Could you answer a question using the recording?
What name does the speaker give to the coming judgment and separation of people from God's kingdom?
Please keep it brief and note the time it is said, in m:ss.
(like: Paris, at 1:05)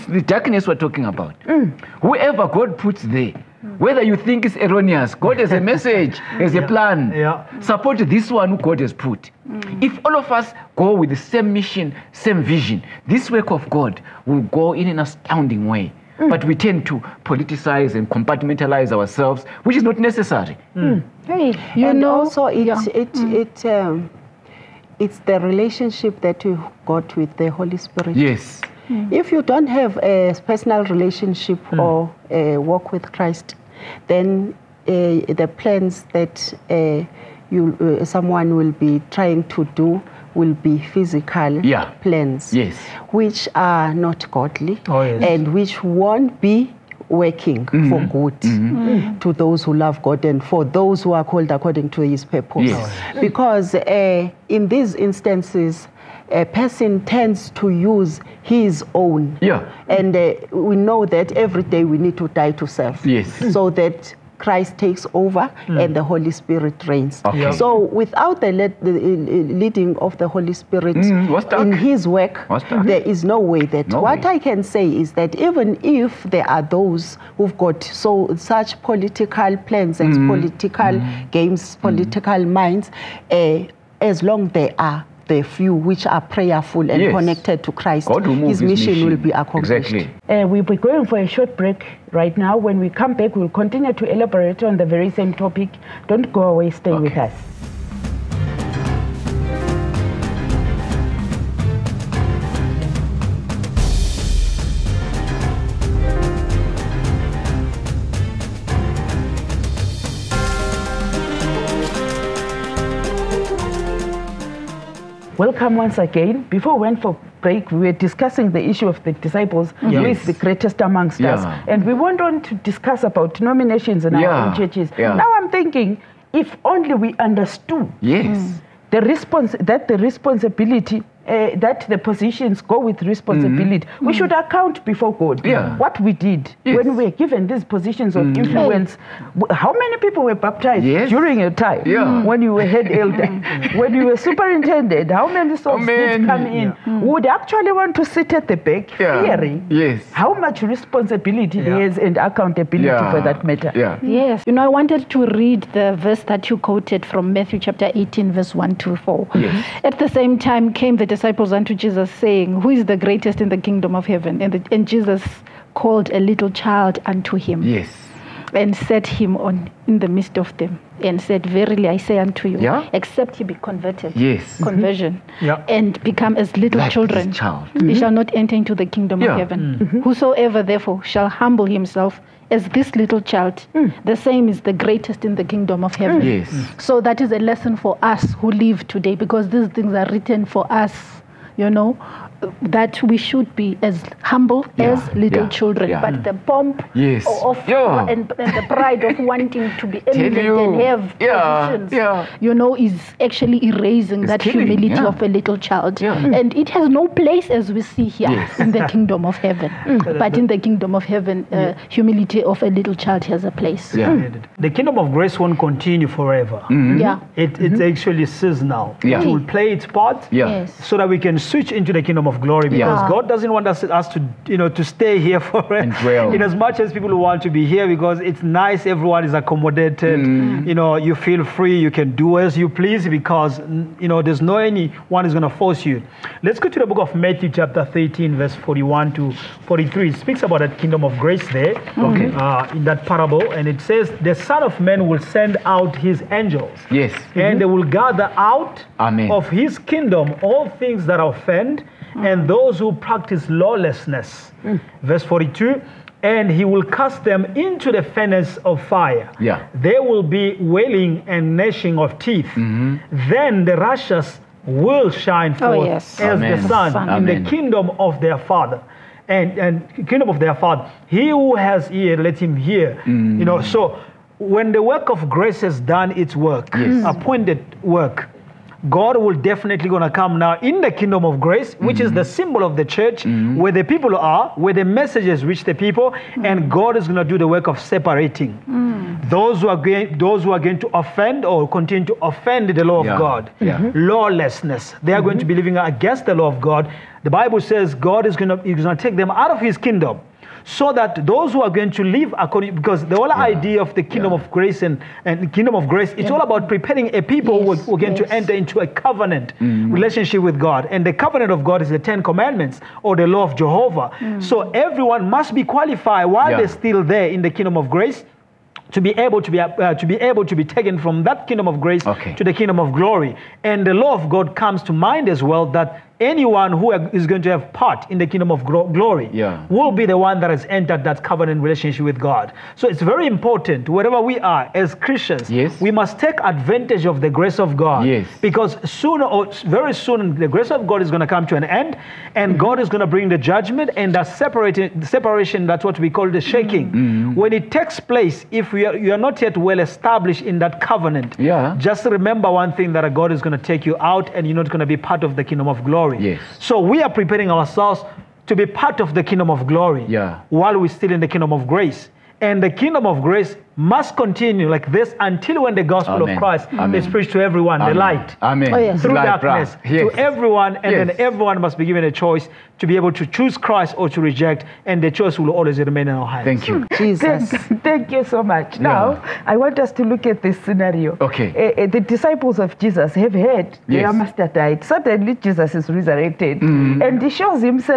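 The shaking, at 5:46.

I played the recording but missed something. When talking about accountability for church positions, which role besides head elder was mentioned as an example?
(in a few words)
Superintendent.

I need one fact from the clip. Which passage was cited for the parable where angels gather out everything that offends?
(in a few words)
Matthew 13:41-43.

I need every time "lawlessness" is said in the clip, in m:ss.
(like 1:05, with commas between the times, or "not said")
4:13, 4:54.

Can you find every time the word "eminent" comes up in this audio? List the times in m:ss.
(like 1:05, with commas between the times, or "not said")
3:20.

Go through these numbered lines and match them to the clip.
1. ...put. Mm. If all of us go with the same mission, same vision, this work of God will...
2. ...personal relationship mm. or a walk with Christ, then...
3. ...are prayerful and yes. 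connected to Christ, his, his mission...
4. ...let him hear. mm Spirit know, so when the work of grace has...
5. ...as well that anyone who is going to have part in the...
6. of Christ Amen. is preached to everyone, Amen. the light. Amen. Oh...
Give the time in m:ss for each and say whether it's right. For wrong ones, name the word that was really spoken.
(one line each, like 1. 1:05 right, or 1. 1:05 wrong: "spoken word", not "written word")
1. 0:08 right
2. 0:30 right
3. 1:26 right
4. 4:32 wrong: "You", not "Spirit"
5. 5:25 right
6. 6:06 right.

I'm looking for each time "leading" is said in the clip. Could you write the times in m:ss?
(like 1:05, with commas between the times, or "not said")
1:09.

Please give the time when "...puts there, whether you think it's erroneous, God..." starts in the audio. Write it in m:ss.
0:02.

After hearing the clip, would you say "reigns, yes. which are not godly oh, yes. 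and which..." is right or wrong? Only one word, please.
wrong.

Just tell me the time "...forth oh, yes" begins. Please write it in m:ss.
4:25.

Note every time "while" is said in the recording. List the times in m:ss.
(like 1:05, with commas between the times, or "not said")
5:16, 6:00.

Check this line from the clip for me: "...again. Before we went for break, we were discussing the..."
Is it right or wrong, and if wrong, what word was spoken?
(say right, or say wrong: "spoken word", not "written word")
right.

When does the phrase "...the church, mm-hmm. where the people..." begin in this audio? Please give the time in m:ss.
4:42.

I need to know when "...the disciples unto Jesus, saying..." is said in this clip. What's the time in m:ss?
2:40.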